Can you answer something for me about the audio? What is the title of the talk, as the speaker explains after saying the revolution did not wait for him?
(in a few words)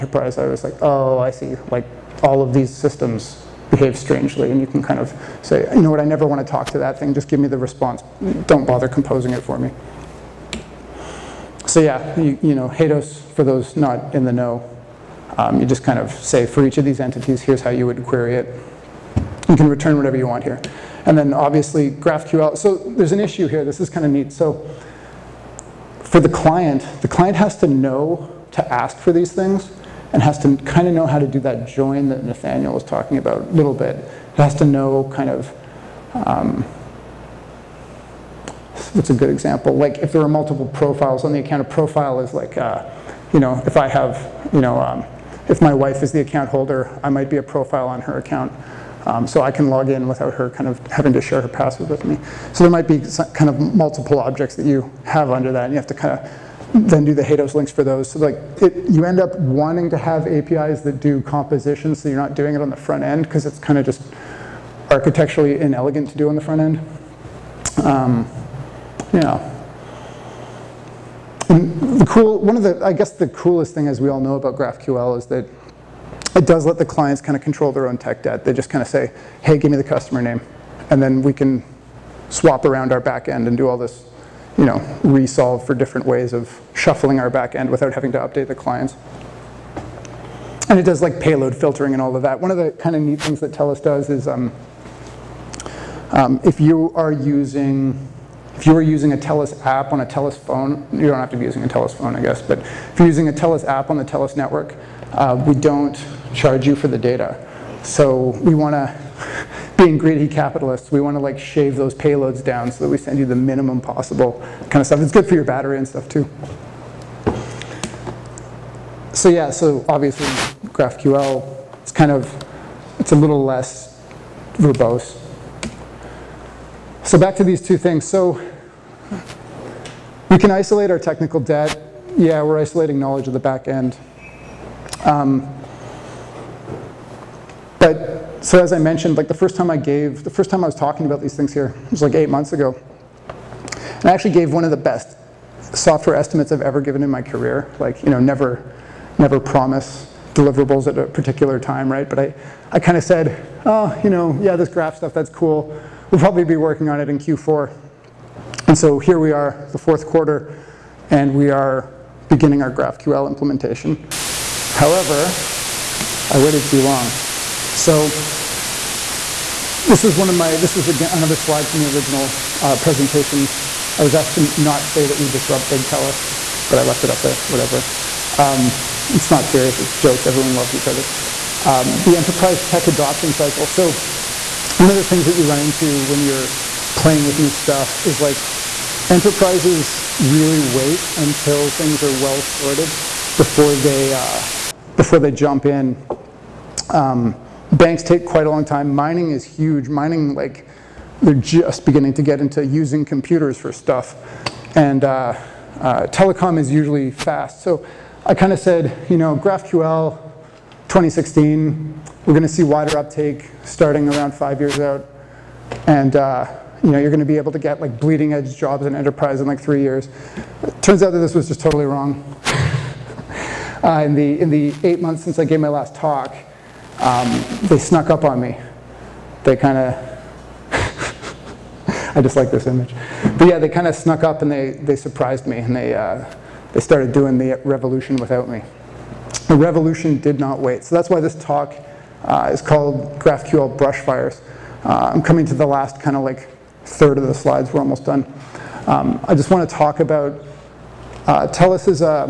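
GraphQL Brush Fires.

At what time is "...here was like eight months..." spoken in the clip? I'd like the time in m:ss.
2:21.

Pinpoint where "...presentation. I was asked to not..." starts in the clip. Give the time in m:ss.
2:52.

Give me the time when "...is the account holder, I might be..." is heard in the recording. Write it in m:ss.
0:46.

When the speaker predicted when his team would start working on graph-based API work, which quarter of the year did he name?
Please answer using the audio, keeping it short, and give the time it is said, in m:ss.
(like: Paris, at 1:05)
Q4, at 2:37.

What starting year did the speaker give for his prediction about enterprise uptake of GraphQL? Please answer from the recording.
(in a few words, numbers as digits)
2016.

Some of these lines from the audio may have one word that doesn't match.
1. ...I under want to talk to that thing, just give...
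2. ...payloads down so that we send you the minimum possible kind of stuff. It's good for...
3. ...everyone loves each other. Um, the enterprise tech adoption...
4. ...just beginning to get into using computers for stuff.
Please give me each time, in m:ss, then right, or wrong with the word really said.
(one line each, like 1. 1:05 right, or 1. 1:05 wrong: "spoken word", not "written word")
1. 0:05 wrong: "never", not "under"
2. 1:51 right
3. 3:00 right
4. 3:21 right.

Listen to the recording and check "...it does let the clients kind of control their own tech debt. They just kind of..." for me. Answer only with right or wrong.
right.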